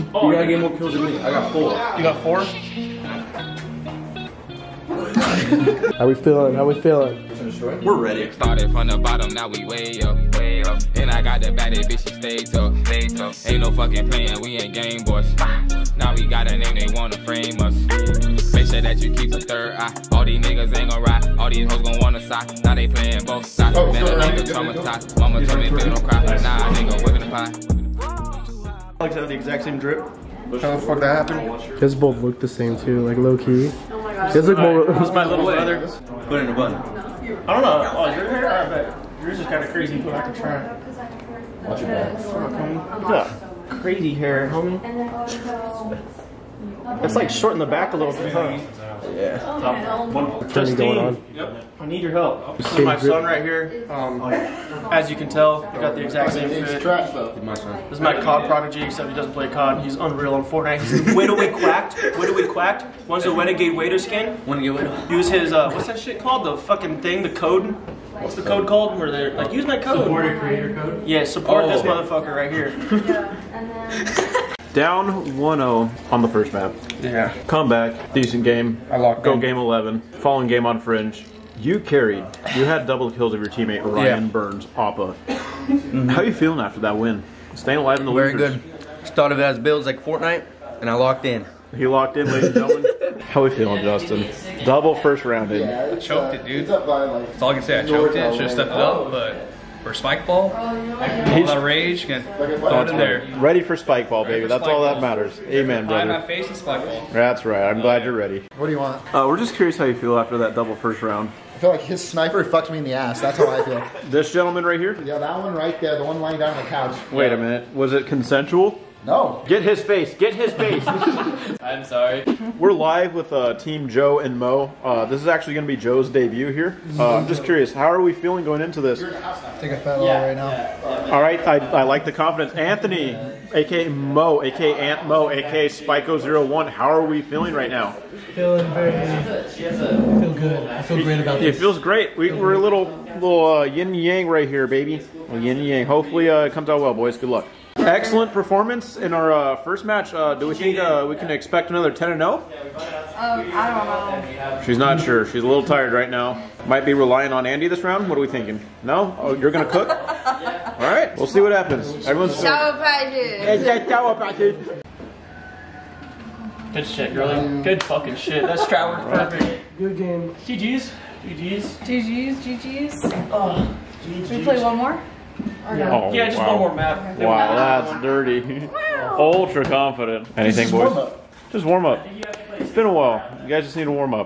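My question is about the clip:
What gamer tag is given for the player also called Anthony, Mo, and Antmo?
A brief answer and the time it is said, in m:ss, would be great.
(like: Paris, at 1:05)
Spiko01, at 2:15.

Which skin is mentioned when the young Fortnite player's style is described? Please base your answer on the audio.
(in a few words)
Renegade Raider.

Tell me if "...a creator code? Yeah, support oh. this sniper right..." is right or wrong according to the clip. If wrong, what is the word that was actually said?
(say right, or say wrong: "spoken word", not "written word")
wrong: "motherfucker", not "sniper".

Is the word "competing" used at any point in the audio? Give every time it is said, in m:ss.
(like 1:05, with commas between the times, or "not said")
not said.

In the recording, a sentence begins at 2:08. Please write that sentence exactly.
Take a fat yeah, right now.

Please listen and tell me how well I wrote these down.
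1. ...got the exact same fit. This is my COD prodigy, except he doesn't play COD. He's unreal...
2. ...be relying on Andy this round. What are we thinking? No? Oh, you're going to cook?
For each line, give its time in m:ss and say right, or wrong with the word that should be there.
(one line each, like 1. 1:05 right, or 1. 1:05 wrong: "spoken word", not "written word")
1. 0:55 right
2. 2:36 right.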